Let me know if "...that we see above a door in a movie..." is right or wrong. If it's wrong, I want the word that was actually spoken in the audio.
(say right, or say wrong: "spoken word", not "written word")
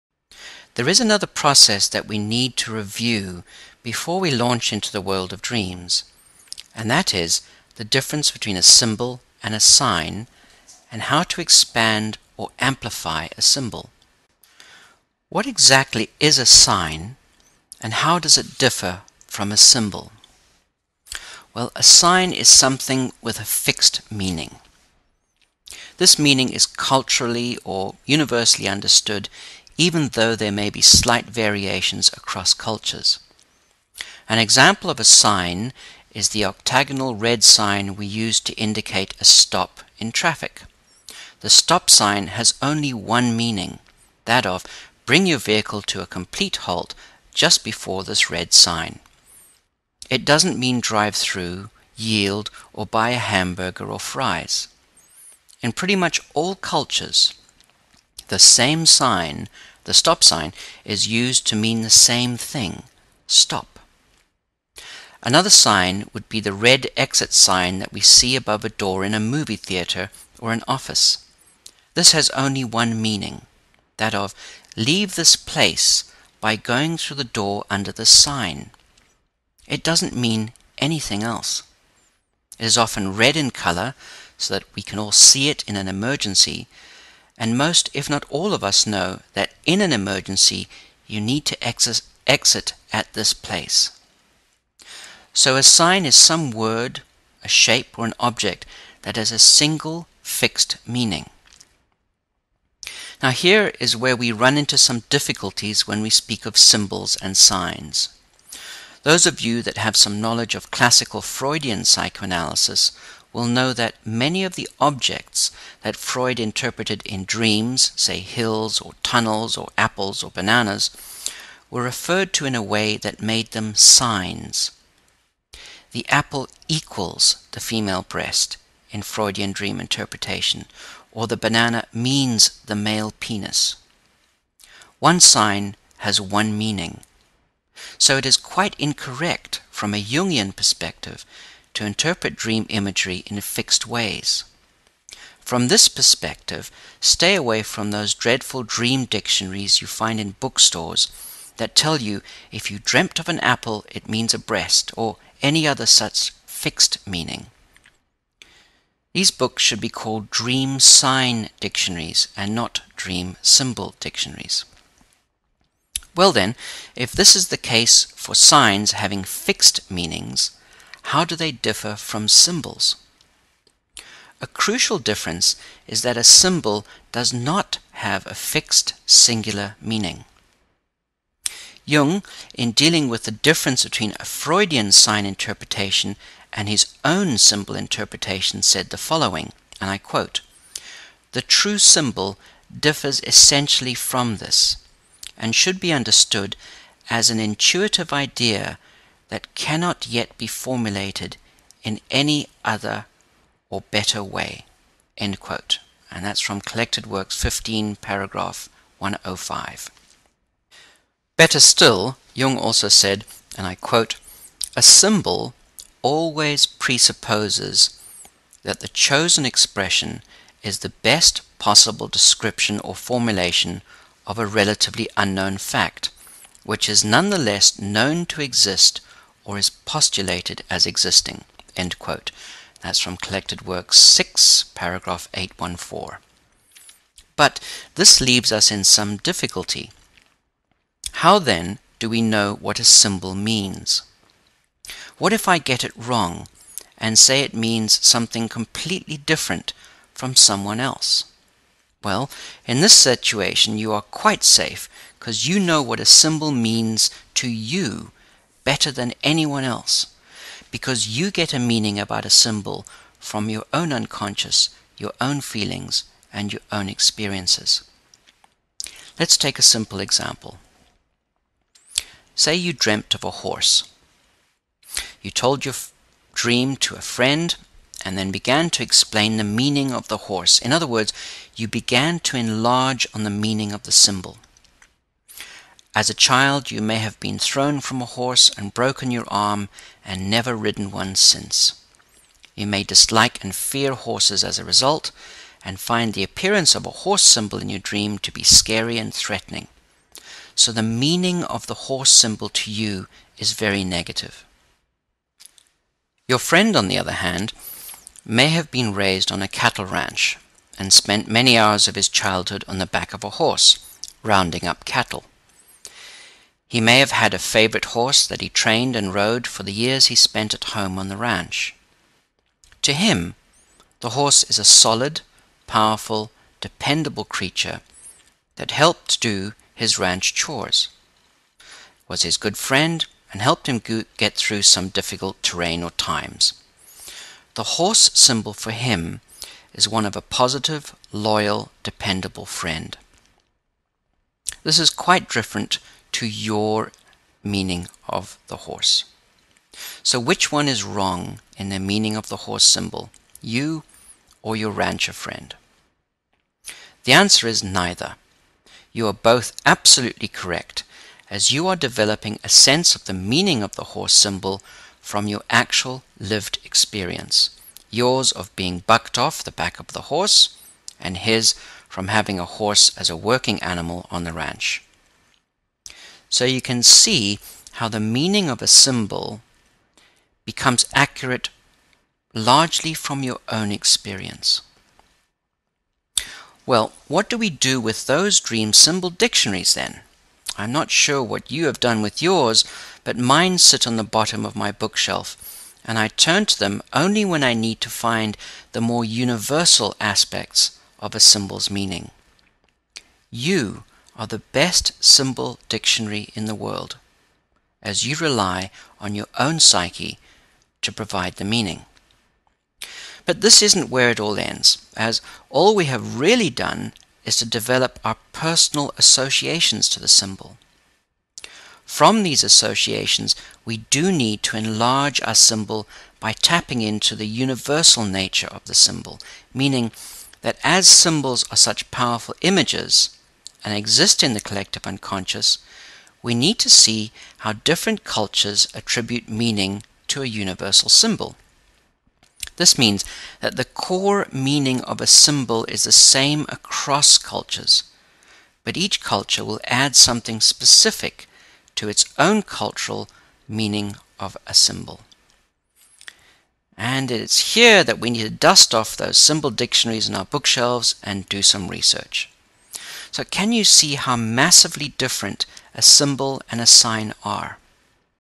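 right.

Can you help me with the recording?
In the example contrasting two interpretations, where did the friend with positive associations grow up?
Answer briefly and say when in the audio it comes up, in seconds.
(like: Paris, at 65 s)
A cattle ranch, at 309 s.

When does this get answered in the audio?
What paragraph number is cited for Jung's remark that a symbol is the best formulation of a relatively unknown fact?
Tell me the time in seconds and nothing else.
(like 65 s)
234 s.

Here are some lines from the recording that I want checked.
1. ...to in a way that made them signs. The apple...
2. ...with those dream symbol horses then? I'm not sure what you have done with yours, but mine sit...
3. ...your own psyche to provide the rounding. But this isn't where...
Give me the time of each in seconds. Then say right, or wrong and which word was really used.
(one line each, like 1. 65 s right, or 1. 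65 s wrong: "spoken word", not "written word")
1. 122 s right
2. 387 s wrong: "dictionaries", not "horses"
3. 409 s wrong: "meaning", not "rounding".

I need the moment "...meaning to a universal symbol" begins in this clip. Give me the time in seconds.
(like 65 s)
439 s.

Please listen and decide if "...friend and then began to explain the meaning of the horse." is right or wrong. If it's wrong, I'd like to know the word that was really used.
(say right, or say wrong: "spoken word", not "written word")
right.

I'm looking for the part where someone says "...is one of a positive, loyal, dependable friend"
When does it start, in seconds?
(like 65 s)
339 s.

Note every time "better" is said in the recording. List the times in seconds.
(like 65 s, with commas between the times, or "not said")
203 s, 211 s, 258 s.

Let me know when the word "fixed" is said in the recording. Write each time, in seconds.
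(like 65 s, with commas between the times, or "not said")
23 s, 100 s, 143 s, 156 s, 169 s, 178 s.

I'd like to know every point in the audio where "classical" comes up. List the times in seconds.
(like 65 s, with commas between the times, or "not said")
110 s.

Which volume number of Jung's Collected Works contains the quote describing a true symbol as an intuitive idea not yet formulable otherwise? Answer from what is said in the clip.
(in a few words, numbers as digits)
15.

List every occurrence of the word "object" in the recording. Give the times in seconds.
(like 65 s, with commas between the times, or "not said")
98 s, 114 s.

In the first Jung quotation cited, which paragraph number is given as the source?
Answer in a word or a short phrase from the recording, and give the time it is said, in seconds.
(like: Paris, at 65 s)
105, at 207 s.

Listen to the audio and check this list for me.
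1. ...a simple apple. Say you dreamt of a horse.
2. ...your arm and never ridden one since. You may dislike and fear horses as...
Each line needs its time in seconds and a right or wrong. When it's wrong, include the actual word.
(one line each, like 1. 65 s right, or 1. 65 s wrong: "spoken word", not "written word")
1. 269 s wrong: "example", not "apple"
2. 289 s right.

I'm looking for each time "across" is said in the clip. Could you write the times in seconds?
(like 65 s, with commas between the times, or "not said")
32 s, 446 s.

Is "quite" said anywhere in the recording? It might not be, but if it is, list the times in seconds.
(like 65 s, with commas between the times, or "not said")
138 s, 254 s, 344 s.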